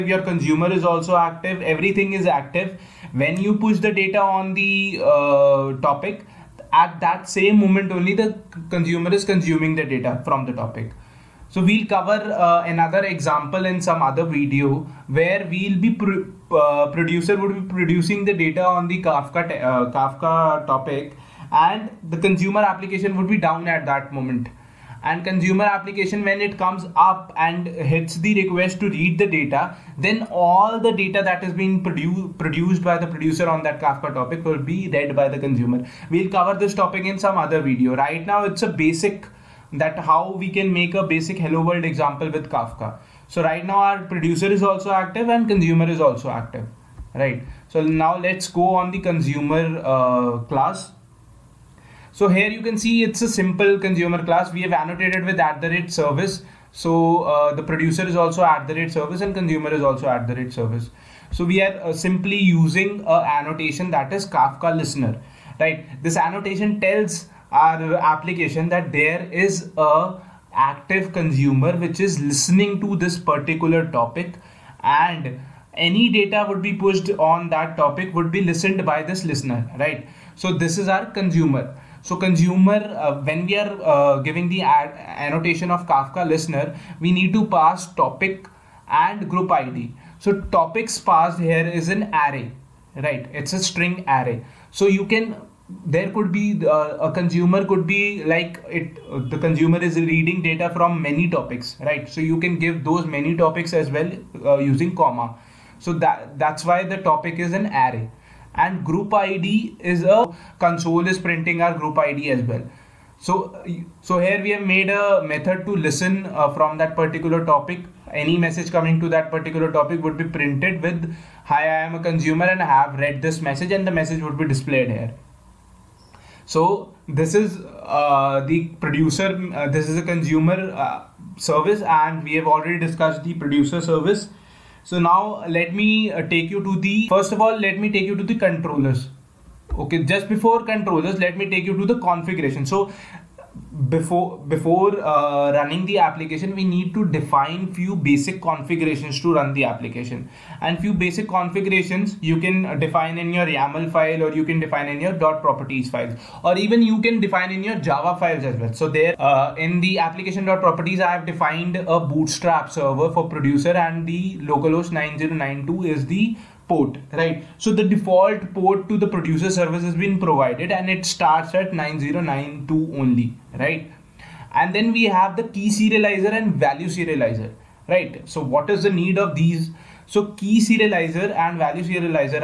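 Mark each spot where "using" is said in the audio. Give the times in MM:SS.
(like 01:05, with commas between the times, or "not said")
01:02, 01:44.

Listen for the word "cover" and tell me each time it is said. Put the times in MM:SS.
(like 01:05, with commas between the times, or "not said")
00:11, 00:36.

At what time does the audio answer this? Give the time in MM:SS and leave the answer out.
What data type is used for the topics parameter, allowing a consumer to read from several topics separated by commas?
01:33.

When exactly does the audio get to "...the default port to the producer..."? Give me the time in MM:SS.
02:47.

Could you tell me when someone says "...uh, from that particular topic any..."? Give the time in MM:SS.
01:56.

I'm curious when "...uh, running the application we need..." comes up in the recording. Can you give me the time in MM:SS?
02:24.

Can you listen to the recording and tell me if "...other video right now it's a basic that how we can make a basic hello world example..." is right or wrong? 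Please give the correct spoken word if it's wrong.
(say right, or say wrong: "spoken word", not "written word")
right.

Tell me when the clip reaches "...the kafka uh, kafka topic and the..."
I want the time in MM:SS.
00:18.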